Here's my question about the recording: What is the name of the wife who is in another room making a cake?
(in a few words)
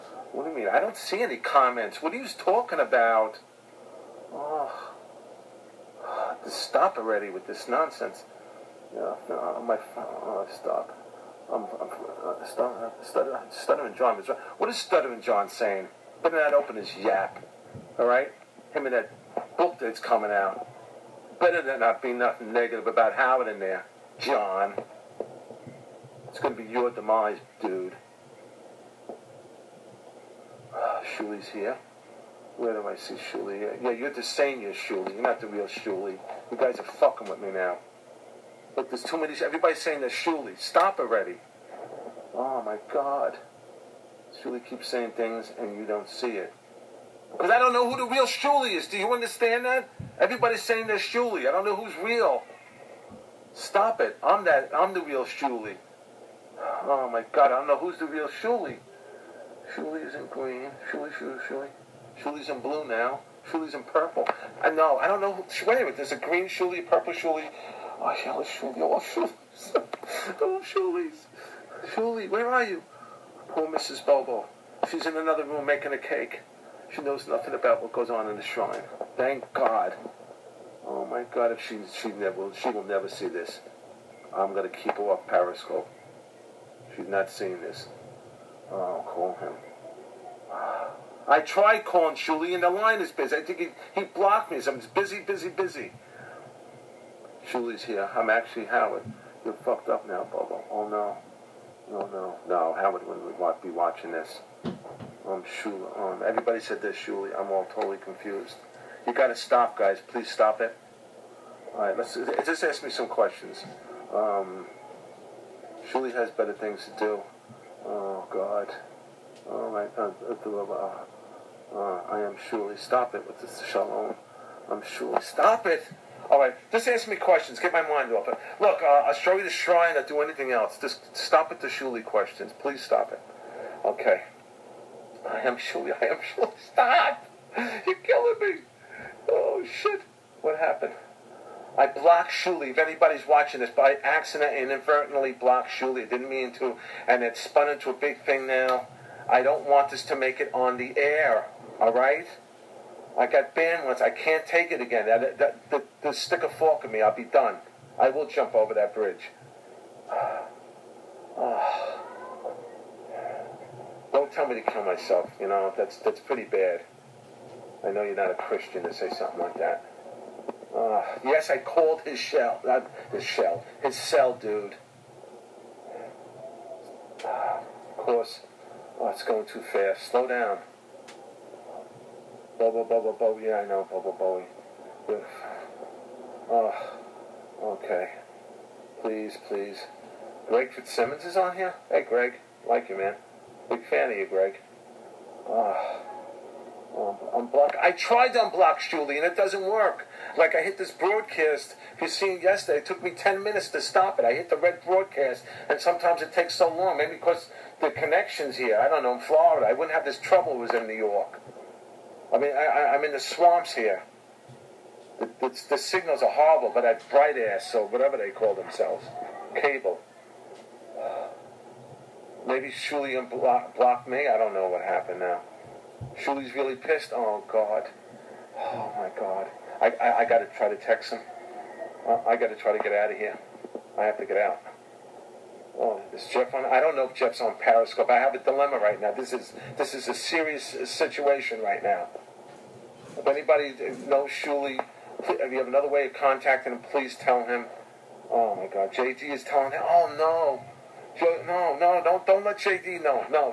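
Mrs. Bobo.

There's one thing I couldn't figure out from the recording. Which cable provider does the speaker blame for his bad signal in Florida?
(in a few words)
Bright House.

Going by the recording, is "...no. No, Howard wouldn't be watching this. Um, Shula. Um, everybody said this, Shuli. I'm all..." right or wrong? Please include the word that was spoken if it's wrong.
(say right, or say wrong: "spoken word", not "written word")
right.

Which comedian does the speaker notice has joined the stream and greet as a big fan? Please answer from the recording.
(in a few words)
Greg Fitzsimmons.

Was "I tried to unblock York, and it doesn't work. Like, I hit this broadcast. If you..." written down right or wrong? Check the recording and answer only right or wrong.
wrong.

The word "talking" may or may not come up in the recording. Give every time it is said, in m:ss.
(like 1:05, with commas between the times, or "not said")
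0:02.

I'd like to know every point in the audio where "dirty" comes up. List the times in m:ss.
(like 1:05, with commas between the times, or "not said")
not said.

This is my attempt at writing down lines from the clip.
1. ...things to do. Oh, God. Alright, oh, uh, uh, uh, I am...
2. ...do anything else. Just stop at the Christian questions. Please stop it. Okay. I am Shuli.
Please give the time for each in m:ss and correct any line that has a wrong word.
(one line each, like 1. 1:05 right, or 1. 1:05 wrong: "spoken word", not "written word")
1. 1:56 right
2. 2:10 wrong: "Shuli", not "Christian".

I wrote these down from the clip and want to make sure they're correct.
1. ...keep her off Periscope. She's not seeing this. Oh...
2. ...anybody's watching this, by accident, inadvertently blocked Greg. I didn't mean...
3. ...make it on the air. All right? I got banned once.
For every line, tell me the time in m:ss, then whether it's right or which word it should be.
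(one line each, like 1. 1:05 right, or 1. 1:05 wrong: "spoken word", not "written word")
1. 1:24 right
2. 2:22 wrong: "Shuli", not "Greg"
3. 2:30 right.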